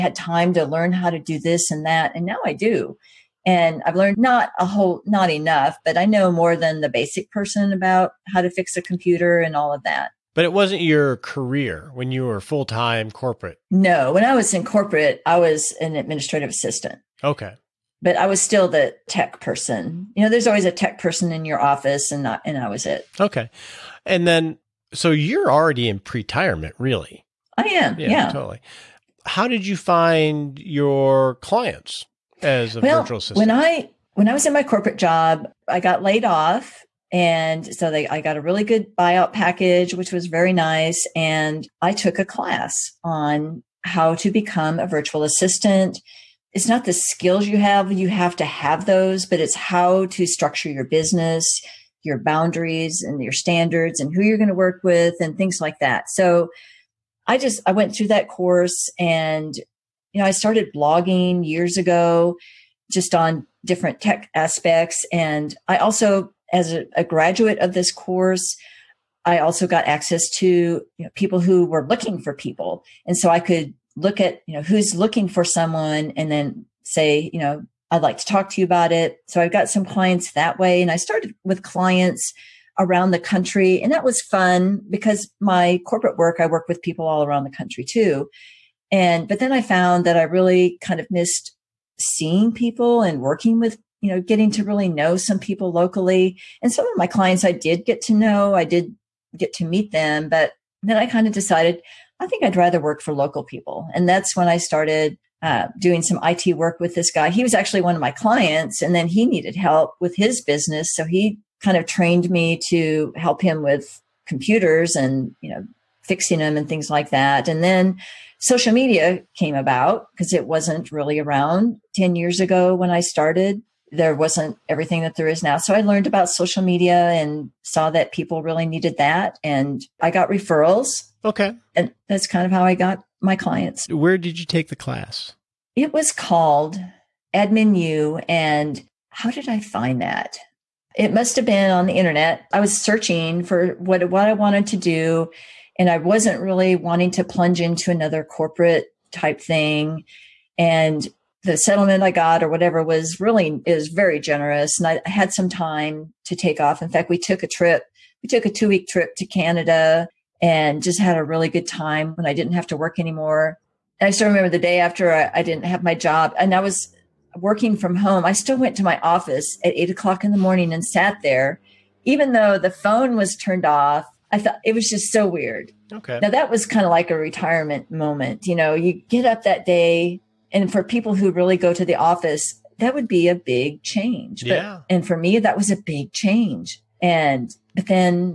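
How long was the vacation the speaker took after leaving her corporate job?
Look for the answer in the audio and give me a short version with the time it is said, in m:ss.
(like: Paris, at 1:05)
2 weeks, at 2:38.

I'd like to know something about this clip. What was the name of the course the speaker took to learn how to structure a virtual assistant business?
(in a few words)
Admin U.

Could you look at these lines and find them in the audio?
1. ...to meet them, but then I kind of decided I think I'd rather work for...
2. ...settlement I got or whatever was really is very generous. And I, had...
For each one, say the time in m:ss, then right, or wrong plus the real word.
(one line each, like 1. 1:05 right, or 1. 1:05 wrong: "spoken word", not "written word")
1. 1:39 right
2. 2:31 right.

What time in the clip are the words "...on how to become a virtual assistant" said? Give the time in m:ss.
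0:43.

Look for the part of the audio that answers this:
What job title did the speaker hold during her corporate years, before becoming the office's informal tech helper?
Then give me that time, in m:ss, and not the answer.
0:15.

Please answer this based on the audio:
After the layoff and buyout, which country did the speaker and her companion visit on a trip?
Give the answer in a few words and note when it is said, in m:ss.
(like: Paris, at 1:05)
Canada, at 2:39.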